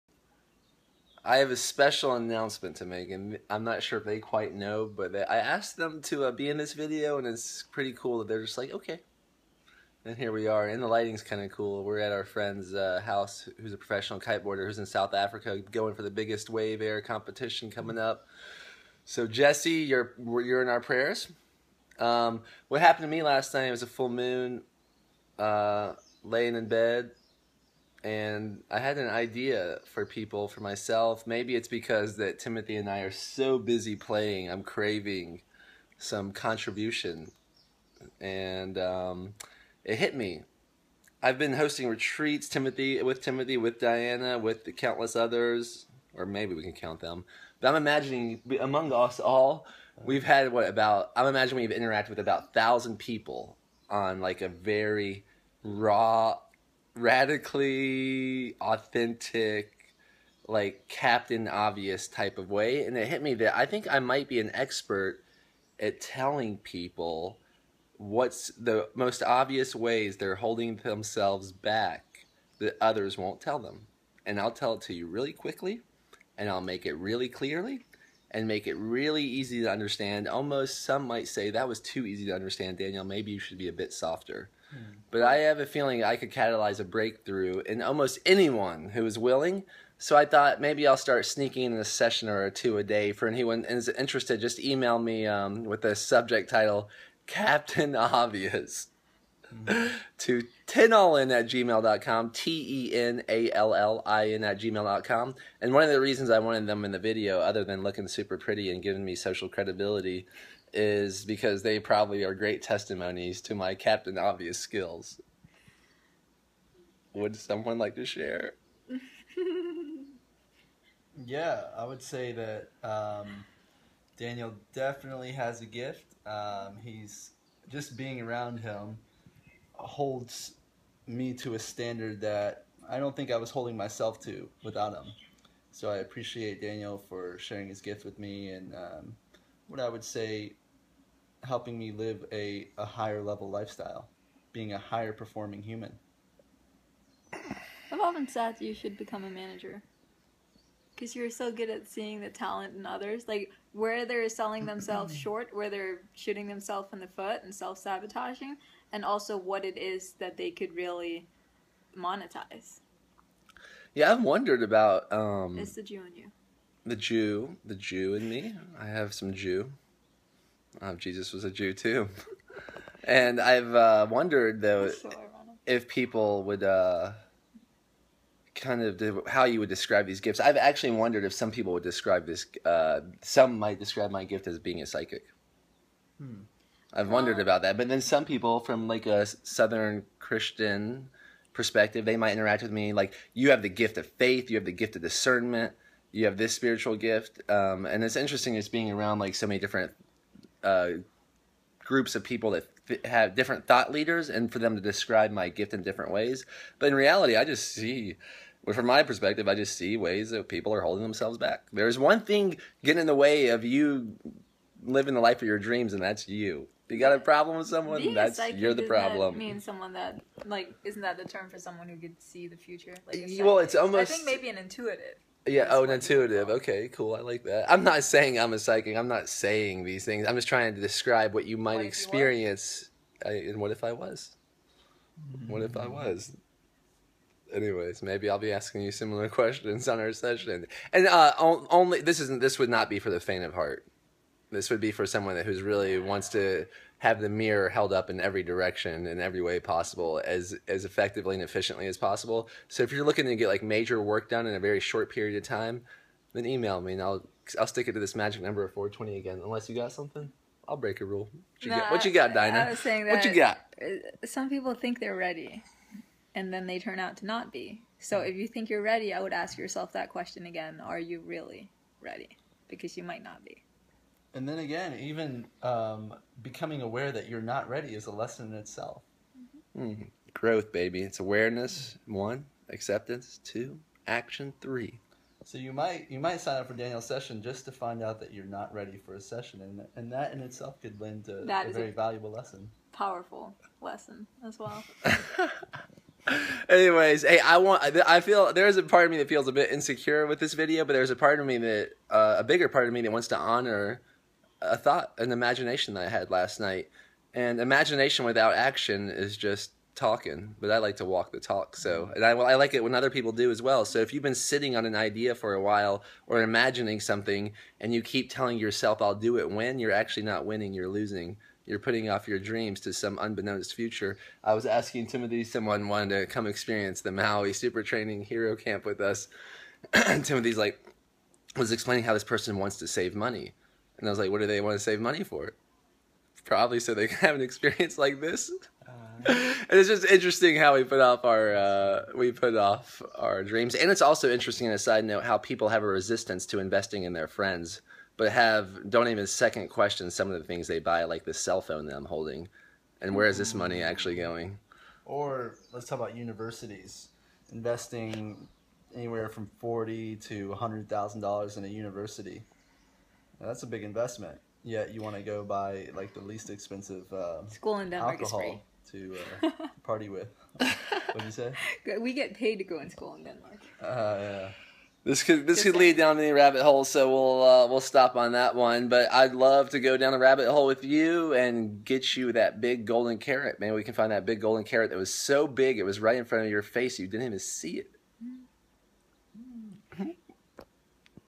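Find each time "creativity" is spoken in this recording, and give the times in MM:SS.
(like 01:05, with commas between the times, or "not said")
not said.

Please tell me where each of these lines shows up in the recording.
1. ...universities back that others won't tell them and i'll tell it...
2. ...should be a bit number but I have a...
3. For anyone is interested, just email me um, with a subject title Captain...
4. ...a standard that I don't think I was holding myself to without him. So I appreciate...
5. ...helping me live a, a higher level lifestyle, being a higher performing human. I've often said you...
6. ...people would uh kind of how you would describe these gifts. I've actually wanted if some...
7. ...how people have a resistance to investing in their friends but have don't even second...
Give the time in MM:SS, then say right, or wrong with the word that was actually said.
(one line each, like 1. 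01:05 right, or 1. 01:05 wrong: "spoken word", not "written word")
1. 01:10 wrong: "themselves", not "universities"
2. 01:23 wrong: "softer", not "number"
3. 01:33 right
4. 02:11 right
5. 02:21 right
6. 02:55 wrong: "wondered", not "wanted"
7. 05:45 right.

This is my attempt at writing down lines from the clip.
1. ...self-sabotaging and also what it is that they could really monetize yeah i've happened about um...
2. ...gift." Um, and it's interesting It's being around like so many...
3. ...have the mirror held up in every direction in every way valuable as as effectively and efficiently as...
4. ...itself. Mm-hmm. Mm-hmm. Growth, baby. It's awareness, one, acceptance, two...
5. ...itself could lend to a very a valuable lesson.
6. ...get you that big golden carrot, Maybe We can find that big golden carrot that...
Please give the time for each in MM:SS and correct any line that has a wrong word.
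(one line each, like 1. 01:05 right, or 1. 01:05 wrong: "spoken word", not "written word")
1. 02:37 wrong: "wondered", not "happened"
2. 03:16 right
3. 04:06 wrong: "possible", not "valuable"
4. 04:38 right
5. 04:50 right
6. 06:21 right.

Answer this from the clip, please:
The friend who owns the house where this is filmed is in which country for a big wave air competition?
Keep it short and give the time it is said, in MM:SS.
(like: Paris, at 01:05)
South Africa, at 00:14.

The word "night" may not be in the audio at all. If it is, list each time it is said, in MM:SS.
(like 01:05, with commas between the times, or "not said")
00:23, 05:06.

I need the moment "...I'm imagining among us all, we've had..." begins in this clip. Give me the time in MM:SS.
00:47.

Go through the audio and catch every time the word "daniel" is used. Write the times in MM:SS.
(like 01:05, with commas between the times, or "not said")
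01:22, 02:04, 02:16, 04:46.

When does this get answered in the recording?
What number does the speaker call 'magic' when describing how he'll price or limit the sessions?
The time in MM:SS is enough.
04:18.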